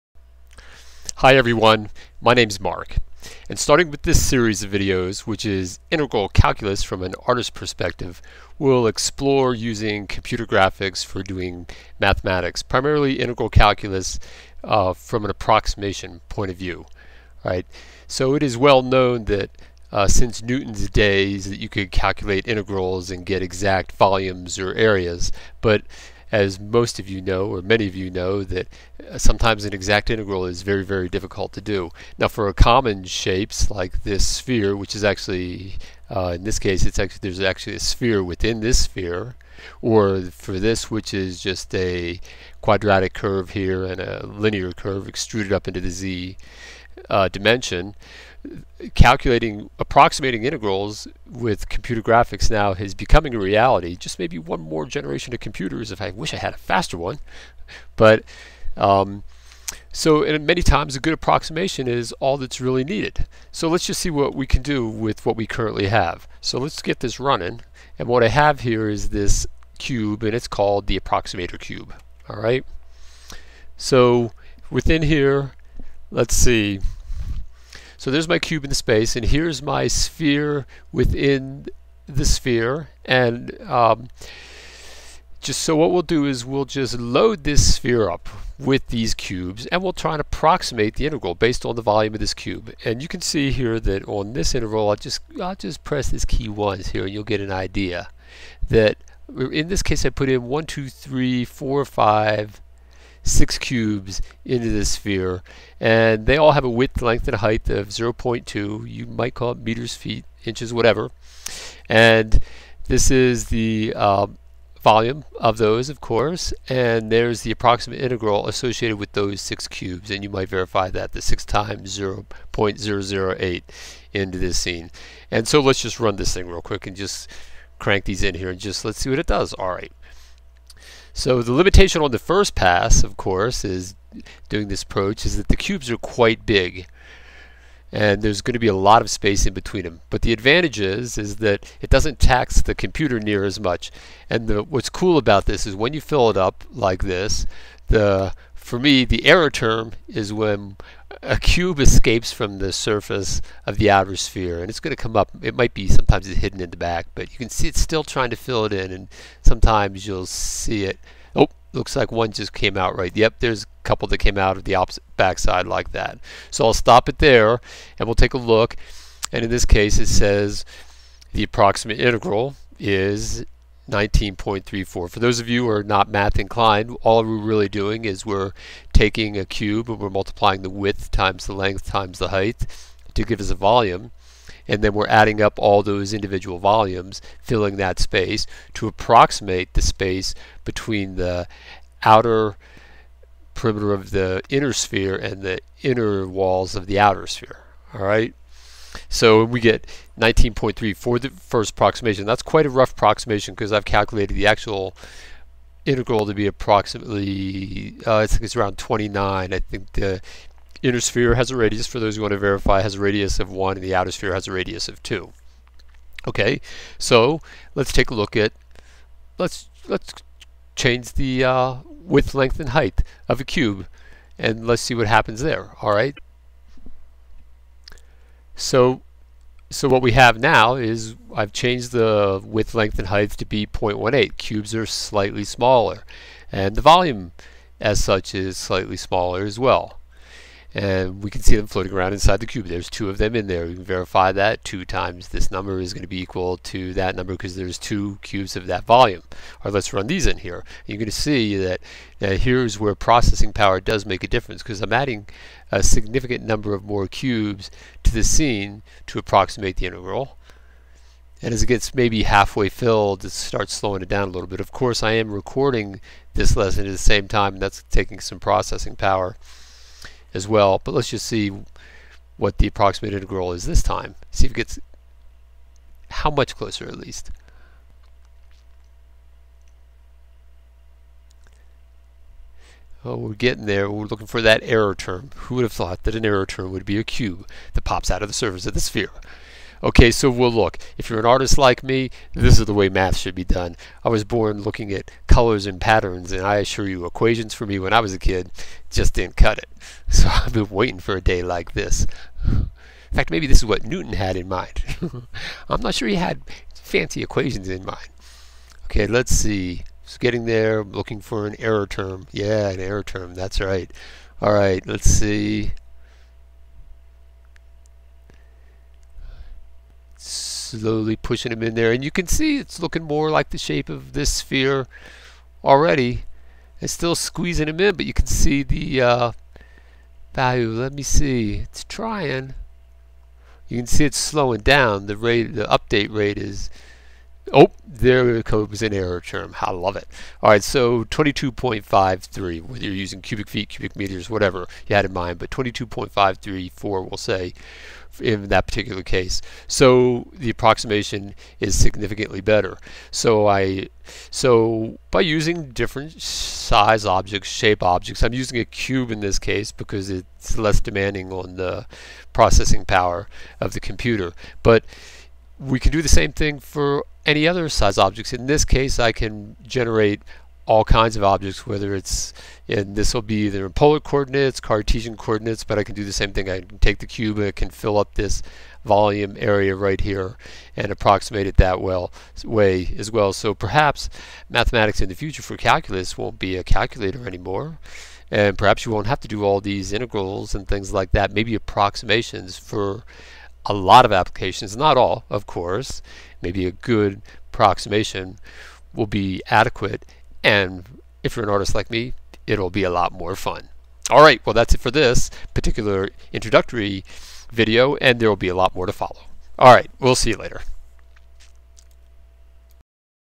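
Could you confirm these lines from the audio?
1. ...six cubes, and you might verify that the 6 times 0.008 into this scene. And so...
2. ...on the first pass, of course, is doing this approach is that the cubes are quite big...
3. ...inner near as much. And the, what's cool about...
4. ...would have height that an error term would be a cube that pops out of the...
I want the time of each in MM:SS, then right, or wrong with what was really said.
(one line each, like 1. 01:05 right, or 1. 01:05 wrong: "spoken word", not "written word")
1. 01:59 right
2. 02:12 right
3. 02:22 wrong: "computer", not "inner"
4. 04:45 wrong: "thought", not "height".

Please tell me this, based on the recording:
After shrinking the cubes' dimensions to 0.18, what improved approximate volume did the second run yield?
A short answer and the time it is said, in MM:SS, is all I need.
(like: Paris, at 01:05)
22.534, at 05:45.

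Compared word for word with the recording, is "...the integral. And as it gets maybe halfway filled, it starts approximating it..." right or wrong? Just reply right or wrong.
wrong.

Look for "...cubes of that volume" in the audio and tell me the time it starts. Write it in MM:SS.
04:08.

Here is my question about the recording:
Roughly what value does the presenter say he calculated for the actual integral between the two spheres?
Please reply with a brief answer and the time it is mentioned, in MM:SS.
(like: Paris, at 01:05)
29, at 03:28.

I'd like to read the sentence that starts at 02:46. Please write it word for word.
So I'll stop it there, and we'll take a look.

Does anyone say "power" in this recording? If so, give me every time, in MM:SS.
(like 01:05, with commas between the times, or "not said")
04:13, 04:28, 06:02.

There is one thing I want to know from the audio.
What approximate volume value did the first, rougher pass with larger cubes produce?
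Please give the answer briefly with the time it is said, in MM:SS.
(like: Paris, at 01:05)
19.34, at 02:53.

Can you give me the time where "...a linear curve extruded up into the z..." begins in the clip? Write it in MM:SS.
00:43.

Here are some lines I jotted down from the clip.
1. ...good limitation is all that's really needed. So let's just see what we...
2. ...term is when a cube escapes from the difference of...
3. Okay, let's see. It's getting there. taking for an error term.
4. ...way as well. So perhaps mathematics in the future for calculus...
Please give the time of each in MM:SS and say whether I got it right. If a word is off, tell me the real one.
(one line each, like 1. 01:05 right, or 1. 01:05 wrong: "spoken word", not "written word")
1. 01:00 wrong: "approximation", not "limitation"
2. 02:29 wrong: "surface", not "difference"
3. 05:08 wrong: "looking", not "taking"
4. 06:22 right.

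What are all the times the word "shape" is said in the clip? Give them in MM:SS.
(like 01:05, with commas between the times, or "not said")
00:33, 05:23, 05:57.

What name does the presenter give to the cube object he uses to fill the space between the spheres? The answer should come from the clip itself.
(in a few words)
approximator cube.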